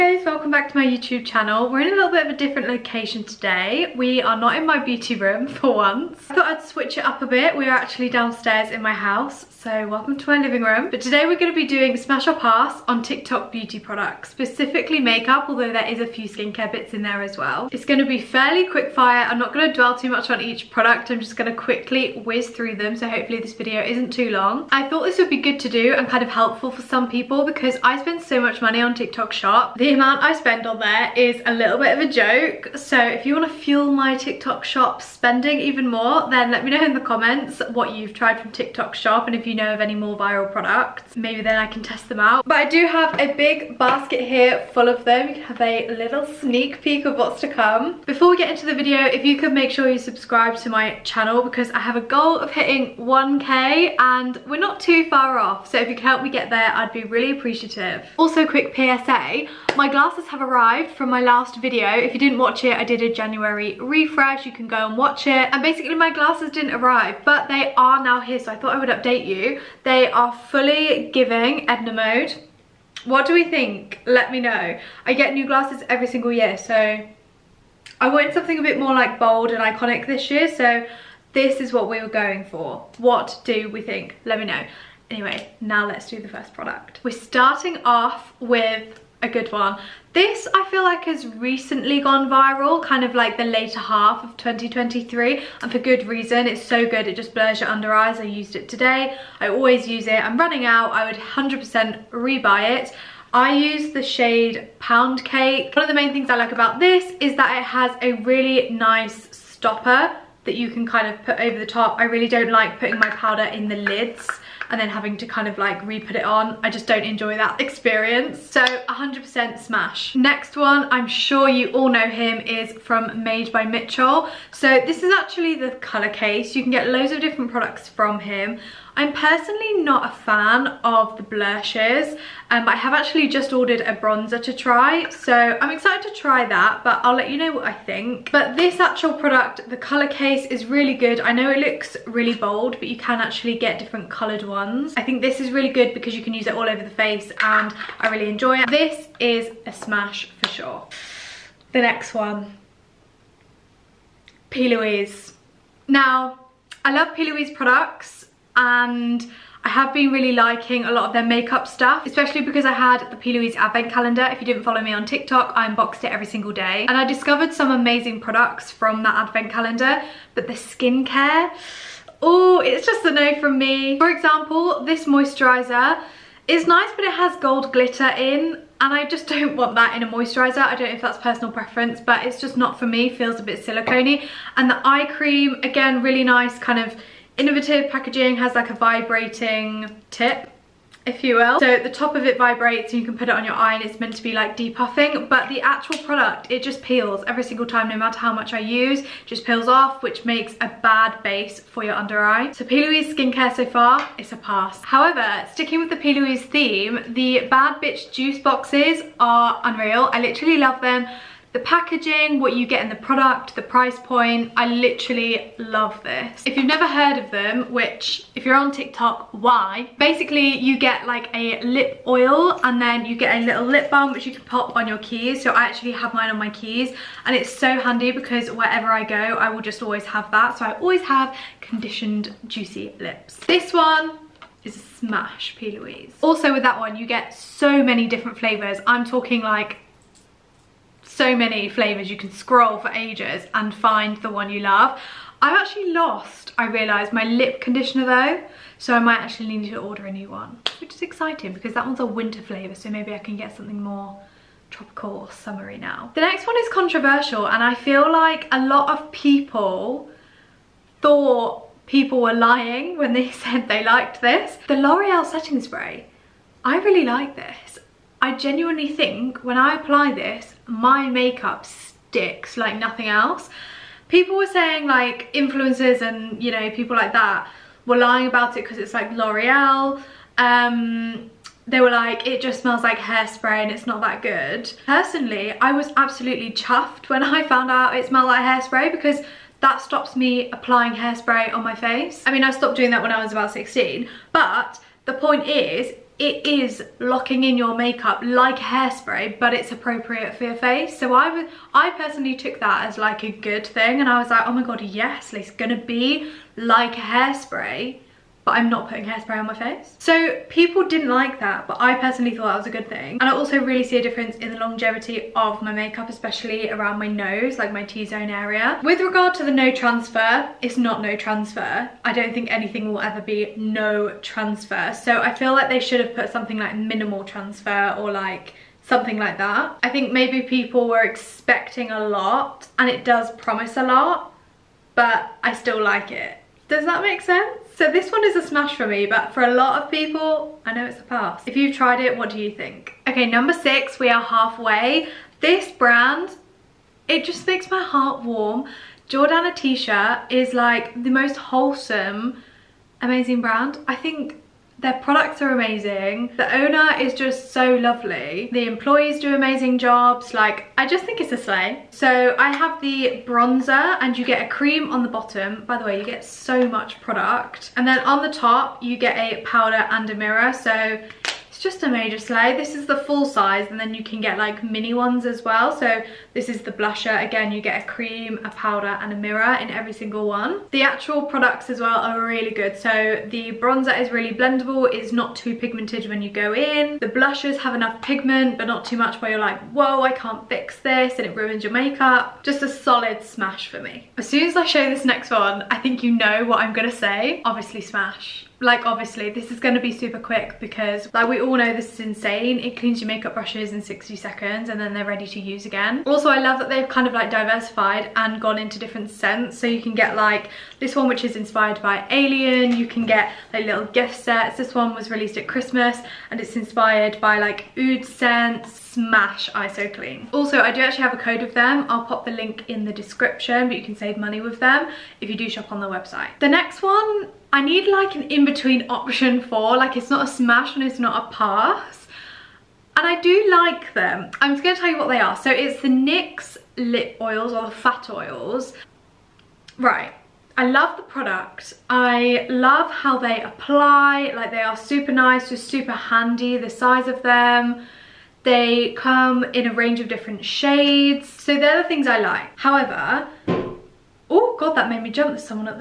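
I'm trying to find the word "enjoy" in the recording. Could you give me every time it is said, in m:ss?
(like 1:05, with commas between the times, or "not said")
1:57, 2:28.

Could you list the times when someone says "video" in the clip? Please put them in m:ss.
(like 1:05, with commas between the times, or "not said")
0:23, 0:48, 1:01.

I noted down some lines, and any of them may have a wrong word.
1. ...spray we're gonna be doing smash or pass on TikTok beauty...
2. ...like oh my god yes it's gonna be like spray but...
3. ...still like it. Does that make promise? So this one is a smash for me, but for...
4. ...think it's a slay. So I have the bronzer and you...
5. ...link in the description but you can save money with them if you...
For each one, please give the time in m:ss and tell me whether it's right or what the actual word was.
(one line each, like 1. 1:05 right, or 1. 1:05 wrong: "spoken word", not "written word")
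1. 0:10 wrong: "today", not "spray"
2. 5:04 wrong: "hairspray", not "spray"
3. 5:35 wrong: "sense", not "promise"
4. 6:01 right
5. 7:02 right.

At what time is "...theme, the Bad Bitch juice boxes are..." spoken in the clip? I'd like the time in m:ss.
3:26.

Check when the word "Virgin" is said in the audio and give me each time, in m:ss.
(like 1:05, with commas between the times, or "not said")
not said.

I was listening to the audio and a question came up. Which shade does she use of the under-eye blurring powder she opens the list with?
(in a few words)
Pound Cake.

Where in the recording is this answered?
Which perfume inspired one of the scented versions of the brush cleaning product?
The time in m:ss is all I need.
6:52.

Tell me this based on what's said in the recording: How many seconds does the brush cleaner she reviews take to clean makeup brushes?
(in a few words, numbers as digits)
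60.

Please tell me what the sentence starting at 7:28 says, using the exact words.
They come in a range of different shades.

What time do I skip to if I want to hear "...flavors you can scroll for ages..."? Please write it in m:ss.
4:01.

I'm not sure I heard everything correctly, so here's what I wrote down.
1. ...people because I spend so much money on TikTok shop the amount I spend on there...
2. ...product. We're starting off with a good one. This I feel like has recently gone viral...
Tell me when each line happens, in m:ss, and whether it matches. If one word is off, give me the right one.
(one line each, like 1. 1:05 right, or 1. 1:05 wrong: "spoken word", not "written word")
1. 0:27 right
2. 1:26 right.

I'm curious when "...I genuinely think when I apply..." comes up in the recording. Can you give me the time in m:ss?
4:28.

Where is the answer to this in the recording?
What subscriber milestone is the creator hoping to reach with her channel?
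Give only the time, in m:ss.
0:52.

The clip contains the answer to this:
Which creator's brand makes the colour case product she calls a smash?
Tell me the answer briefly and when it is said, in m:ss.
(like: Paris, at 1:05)
Made by Mitchell, at 2:03.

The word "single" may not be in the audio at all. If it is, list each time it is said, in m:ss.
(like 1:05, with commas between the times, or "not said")
1:16, 2:46, 3:17, 6:19.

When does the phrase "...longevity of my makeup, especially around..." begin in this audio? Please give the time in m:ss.
5:14.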